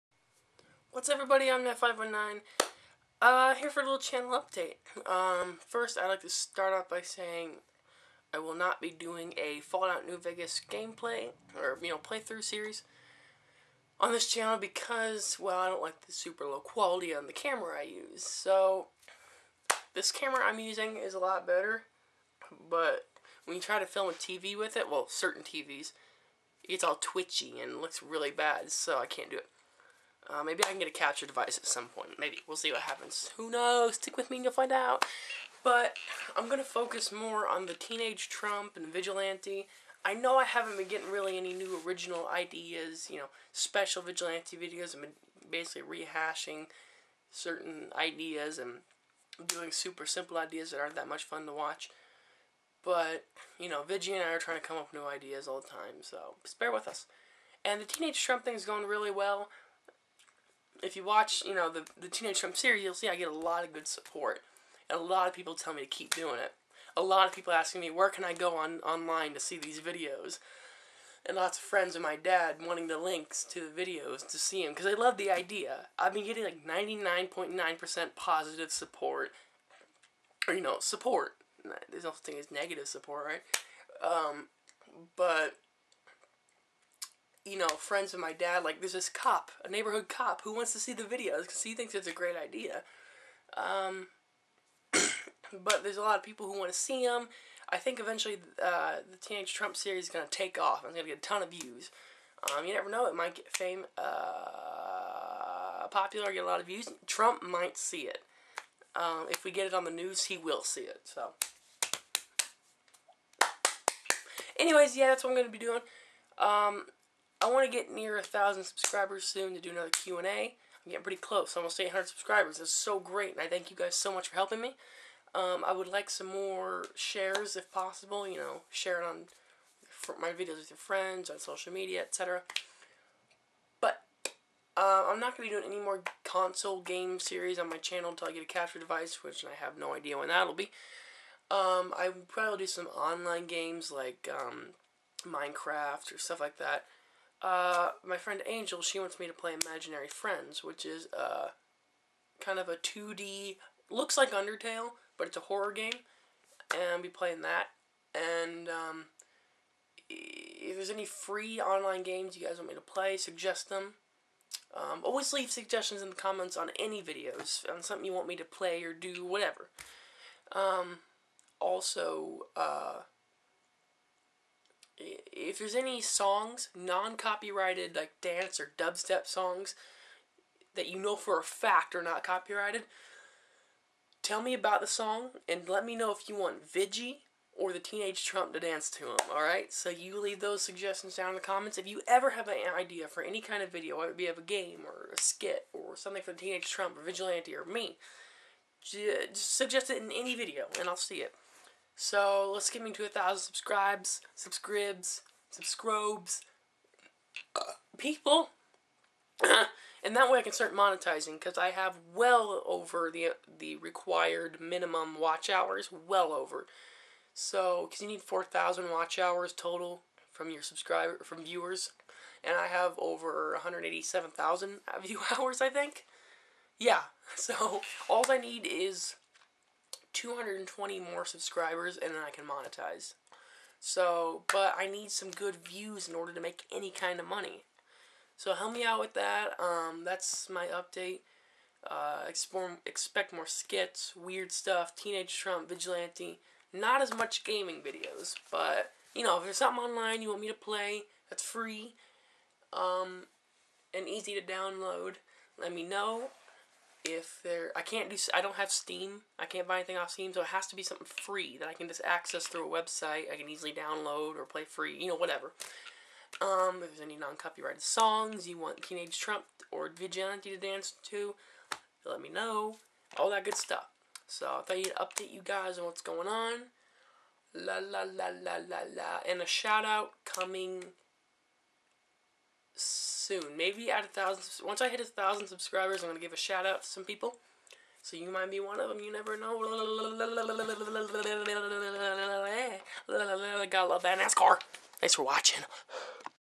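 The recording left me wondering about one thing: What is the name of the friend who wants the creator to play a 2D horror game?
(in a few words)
Angel.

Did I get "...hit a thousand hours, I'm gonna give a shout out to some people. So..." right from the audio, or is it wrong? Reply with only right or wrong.
wrong.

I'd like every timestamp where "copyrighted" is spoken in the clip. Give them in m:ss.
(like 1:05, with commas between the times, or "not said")
2:56, 3:02, 4:27.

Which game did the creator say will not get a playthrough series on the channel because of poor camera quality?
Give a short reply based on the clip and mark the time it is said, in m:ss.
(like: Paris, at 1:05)
Fallout New Vegas, at 0:09.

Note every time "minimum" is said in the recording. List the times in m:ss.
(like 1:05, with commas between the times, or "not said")
3:34.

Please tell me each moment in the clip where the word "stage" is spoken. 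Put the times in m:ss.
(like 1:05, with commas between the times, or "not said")
not said.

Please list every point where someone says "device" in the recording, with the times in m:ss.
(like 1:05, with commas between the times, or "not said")
0:31, 2:18.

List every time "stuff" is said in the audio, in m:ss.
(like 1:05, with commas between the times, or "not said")
2:26, 4:04, 4:33.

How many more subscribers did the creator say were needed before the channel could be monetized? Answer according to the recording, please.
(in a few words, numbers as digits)
220.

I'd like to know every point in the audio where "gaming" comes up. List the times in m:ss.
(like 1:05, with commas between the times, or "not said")
4:07.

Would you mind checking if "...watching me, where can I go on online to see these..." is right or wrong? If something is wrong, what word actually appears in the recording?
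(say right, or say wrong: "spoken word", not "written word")
wrong: "asking", not "watching".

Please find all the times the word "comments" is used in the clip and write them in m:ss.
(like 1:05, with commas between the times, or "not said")
2:46, 3:11.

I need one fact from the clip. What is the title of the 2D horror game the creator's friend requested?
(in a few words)
Imaginary Friends.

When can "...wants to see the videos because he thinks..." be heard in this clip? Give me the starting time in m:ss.
1:30.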